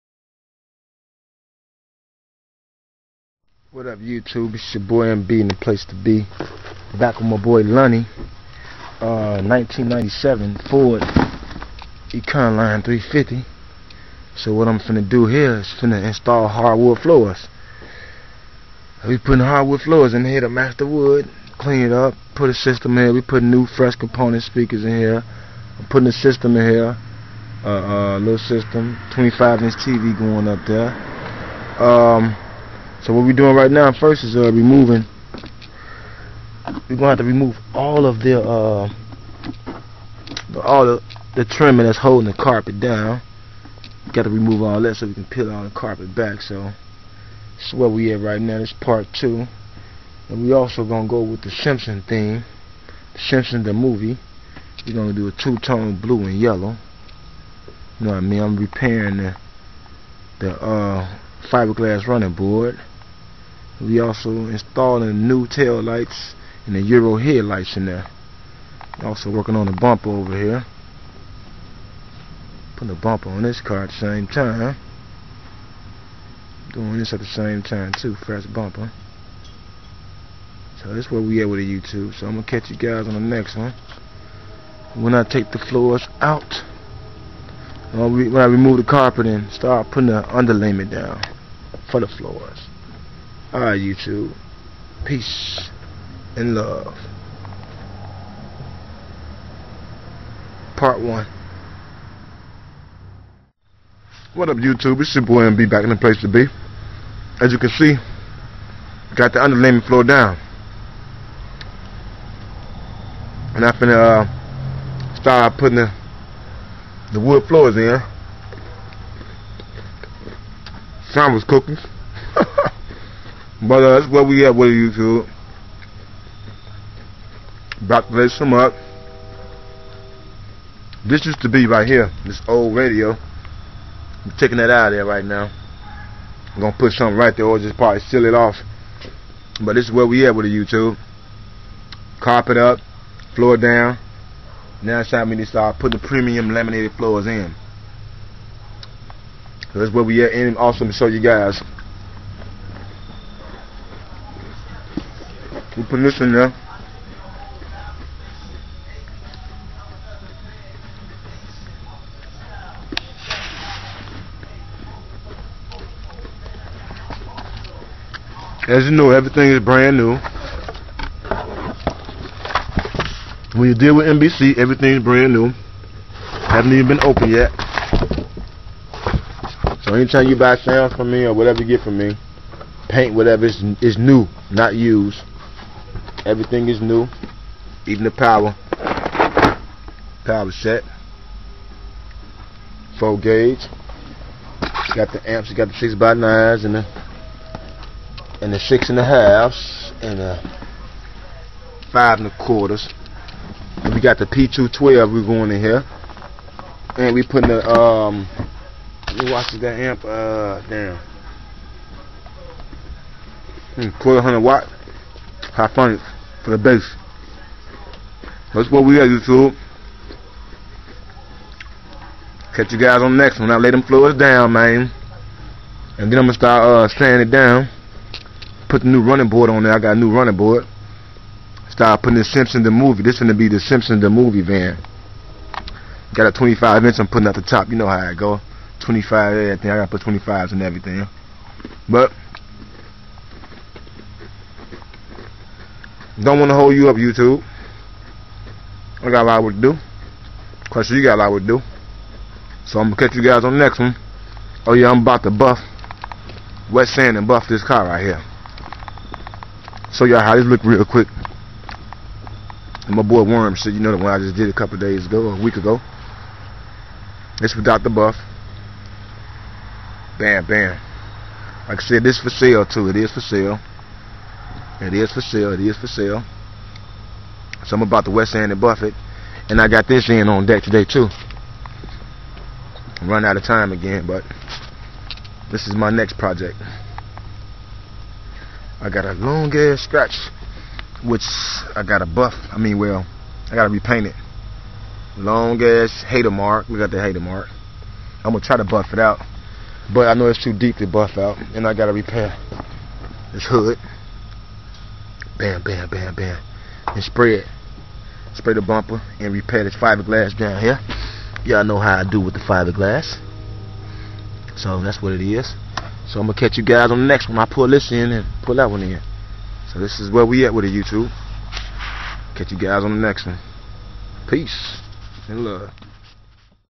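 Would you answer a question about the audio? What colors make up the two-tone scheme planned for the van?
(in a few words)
Blue and yellow.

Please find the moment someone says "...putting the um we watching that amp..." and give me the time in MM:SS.
03:27.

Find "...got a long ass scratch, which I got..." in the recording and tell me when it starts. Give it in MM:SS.
04:48.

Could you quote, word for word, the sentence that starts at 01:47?
As you can see, got the underlayment floor down.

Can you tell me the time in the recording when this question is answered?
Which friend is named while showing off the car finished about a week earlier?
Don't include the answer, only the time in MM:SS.
04:23.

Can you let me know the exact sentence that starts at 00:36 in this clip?
We're gonna have to remove all of the uh, all the, the trimming that's holding the carpet down.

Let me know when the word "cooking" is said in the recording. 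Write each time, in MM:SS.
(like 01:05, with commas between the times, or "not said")
02:01.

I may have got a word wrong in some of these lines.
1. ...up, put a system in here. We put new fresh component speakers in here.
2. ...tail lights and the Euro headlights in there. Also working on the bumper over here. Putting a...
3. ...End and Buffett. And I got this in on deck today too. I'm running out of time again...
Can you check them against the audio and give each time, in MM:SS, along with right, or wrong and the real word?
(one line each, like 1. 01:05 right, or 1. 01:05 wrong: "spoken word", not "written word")
1. 00:21 right
2. 01:05 right
3. 04:38 right.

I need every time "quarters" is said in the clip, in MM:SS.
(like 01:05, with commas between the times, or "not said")
03:22, 03:34.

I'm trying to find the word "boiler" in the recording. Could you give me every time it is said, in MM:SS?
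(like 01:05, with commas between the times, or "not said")
not said.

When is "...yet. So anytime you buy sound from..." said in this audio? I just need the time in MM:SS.
02:57.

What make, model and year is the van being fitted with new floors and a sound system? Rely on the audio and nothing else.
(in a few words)
1997 Ford Econoline 350.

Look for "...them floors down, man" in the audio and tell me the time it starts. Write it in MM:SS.
03:43.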